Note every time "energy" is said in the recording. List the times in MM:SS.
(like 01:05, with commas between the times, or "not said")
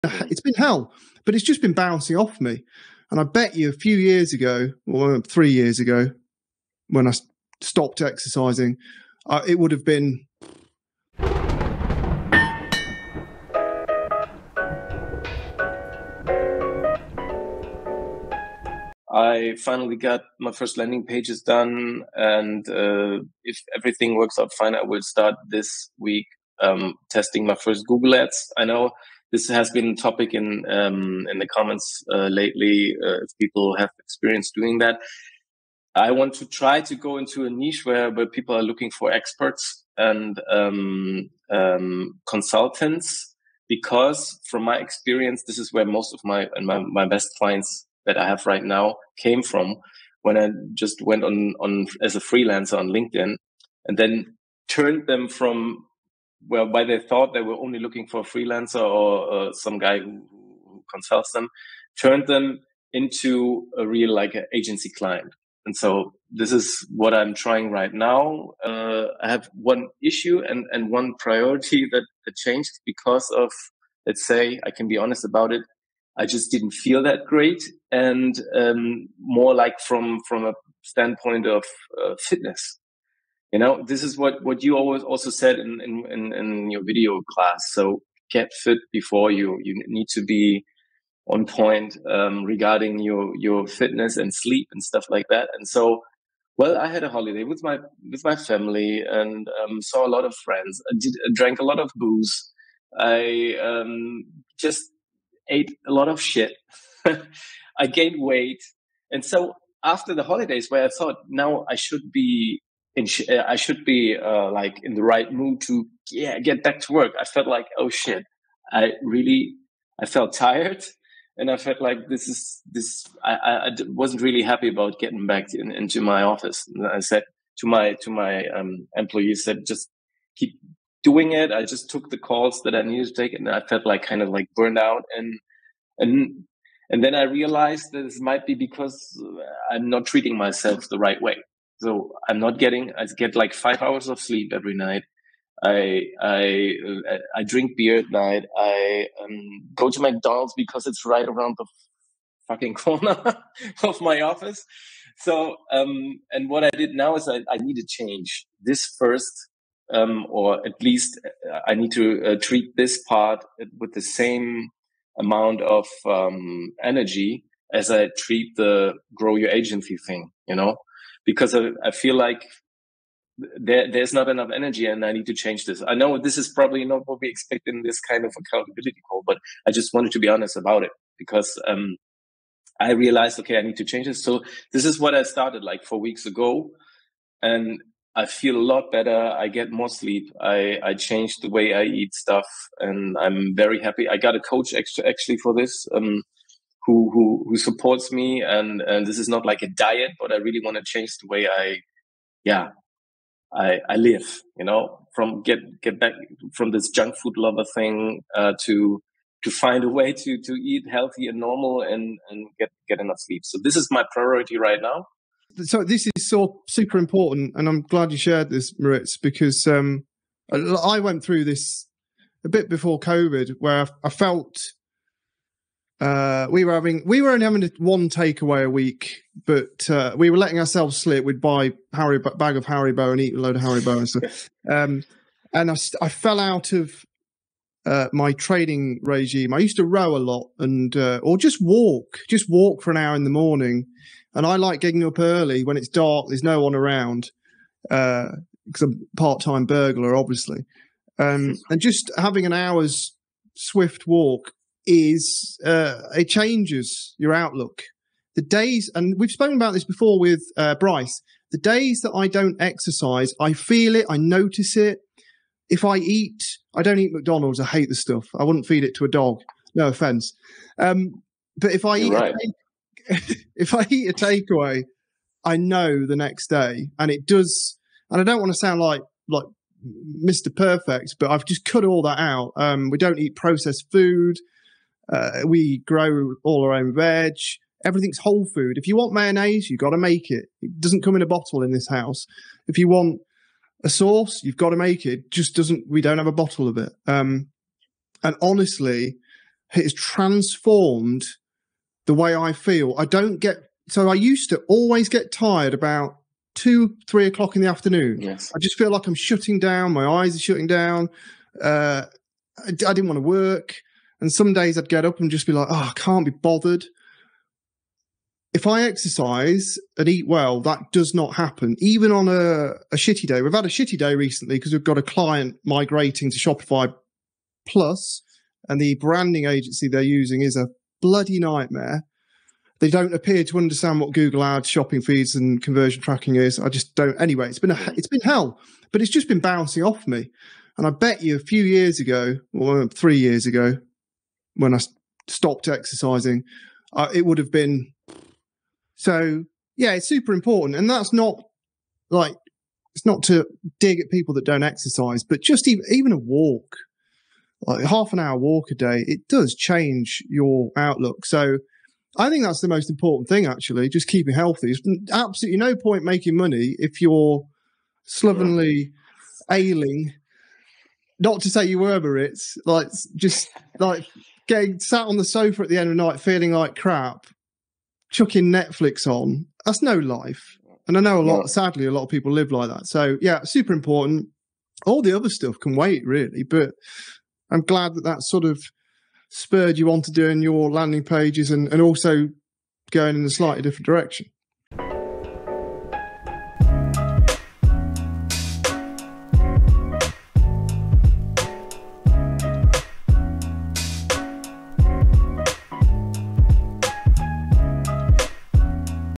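02:46, 02:54.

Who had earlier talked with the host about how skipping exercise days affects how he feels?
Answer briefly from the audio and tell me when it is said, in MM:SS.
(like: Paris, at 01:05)
Bryce, at 04:20.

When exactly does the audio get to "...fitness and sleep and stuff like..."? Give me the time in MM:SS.
01:33.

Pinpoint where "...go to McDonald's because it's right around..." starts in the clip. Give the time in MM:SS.
02:29.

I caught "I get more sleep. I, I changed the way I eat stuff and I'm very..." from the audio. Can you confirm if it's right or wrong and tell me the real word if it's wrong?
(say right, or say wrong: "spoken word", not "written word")
right.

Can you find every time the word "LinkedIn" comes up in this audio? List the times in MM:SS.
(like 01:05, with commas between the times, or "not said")
00:52.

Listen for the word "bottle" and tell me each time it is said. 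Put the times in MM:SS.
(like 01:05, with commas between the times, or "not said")
04:51, 04:56.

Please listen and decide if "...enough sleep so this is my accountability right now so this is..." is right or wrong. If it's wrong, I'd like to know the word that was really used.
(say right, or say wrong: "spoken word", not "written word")
wrong: "priority", not "accountability".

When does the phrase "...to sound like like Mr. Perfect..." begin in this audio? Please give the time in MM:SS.
04:38.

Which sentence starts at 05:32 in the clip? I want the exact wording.
They don't appear to understand what Google Ads, shopping feeds, and conversion tracking is.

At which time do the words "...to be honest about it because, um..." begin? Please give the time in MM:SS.
03:00.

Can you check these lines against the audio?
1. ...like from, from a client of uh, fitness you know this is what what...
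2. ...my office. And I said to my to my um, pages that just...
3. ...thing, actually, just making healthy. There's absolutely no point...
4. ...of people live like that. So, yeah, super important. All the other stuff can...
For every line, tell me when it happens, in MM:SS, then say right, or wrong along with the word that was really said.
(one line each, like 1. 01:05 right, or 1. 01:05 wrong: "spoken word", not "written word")
1. 01:19 wrong: "standpoint", not "client"
2. 02:06 wrong: "employees", not "pages"
3. 06:03 wrong: "keeping", not "making"
4. 06:22 right.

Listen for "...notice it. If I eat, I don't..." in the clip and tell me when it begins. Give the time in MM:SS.
04:24.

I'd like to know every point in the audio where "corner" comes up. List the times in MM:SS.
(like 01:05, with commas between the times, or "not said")
02:32.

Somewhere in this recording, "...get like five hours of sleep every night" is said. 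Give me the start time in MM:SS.
02:23.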